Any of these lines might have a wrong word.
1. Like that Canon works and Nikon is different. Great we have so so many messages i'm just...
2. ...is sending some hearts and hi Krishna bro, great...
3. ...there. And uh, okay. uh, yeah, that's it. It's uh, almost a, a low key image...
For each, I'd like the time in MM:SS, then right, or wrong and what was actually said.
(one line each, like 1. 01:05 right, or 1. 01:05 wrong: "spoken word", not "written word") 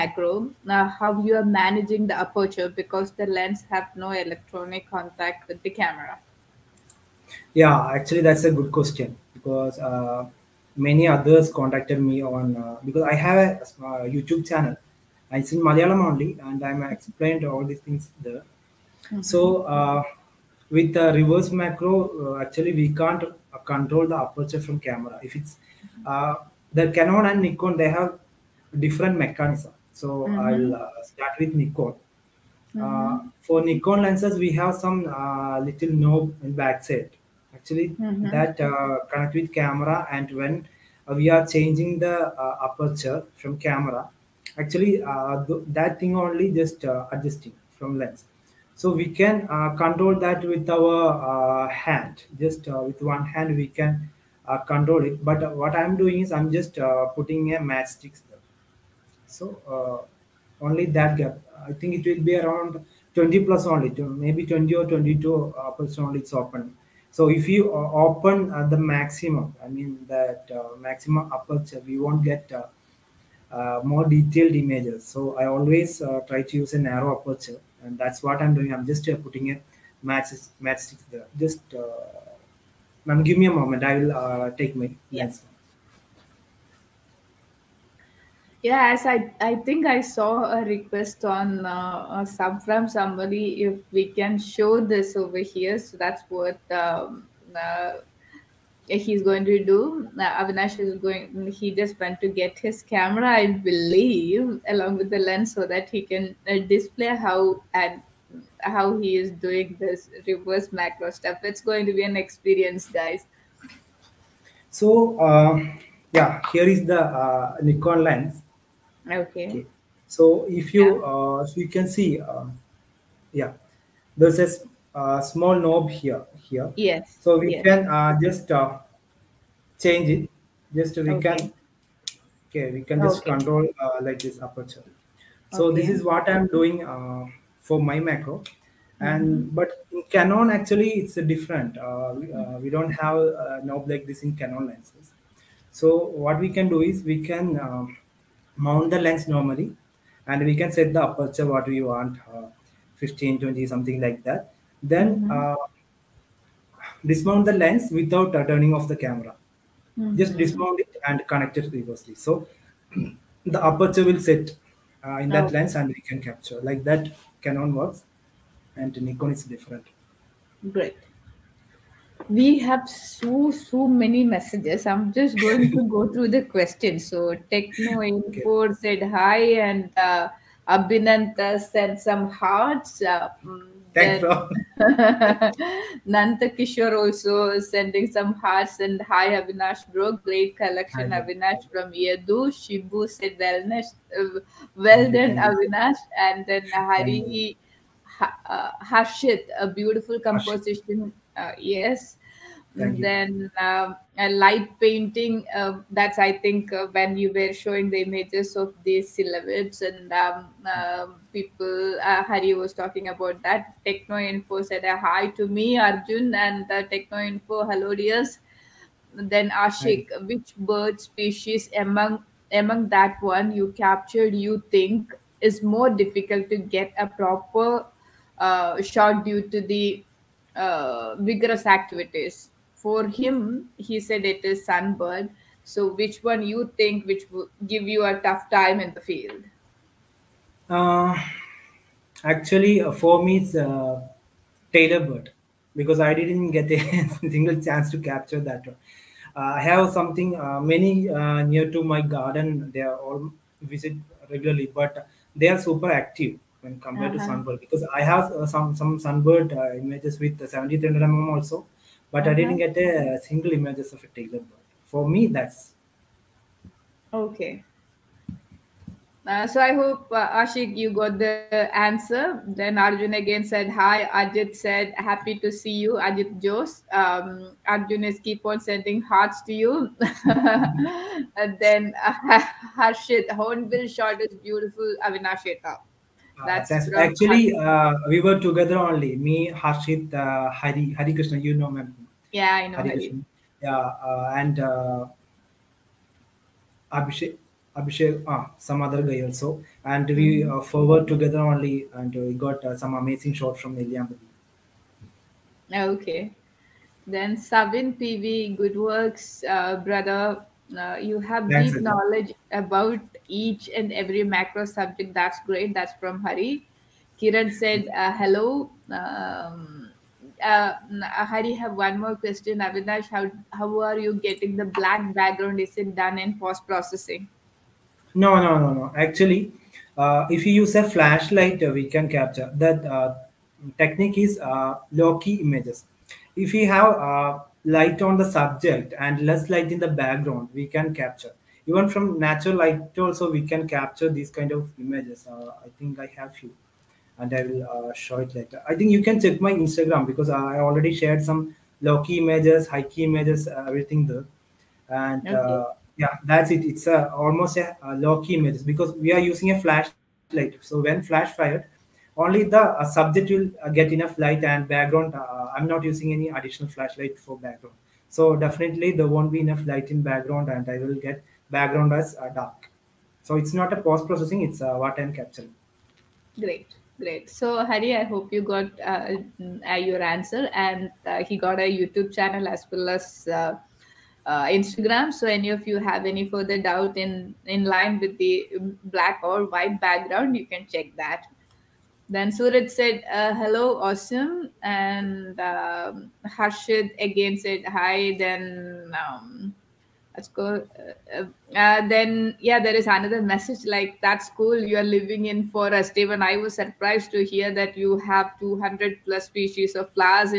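1. 02:46 right
2. 03:07 wrong: "Avinash", not "Krishna"
3. 05:54 right.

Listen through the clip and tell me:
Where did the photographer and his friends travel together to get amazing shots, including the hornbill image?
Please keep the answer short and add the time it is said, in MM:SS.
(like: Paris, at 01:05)
Nelliampathy, at 05:03.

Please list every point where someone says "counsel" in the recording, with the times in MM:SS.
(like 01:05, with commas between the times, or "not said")
not said.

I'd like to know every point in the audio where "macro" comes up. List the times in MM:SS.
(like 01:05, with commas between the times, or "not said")
00:21, 01:50, 02:18, 05:14.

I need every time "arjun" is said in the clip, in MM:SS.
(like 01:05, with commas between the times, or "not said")
03:35, 04:32, 04:37.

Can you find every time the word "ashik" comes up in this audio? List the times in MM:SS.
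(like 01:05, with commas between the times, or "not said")
03:39, 04:30.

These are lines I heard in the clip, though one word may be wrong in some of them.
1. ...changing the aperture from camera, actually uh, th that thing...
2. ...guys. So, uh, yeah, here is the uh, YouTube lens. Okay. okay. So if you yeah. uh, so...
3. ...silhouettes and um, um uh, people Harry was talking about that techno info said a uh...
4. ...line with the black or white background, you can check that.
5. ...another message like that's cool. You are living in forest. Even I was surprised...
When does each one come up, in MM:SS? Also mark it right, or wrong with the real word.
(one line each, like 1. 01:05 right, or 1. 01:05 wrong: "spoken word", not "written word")
1. 00:41 right
2. 01:52 wrong: "Nikon", not "YouTube"
3. 03:29 right
4. 06:27 right
5. 06:42 right.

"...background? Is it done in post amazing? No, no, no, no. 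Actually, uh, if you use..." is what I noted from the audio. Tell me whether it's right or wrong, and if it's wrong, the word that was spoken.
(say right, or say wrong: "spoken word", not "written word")
wrong: "processing", not "amazing".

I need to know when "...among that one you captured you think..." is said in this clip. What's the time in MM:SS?
03:42.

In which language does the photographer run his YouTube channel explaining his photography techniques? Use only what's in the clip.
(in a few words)
Malayalam.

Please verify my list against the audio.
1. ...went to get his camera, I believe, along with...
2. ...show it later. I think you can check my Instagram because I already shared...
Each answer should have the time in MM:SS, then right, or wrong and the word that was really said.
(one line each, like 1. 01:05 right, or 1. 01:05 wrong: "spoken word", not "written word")
1. 01:42 right
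2. 05:47 right.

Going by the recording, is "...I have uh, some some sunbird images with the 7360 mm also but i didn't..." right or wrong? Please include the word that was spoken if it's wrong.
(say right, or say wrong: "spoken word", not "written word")
wrong: "7300", not "7360".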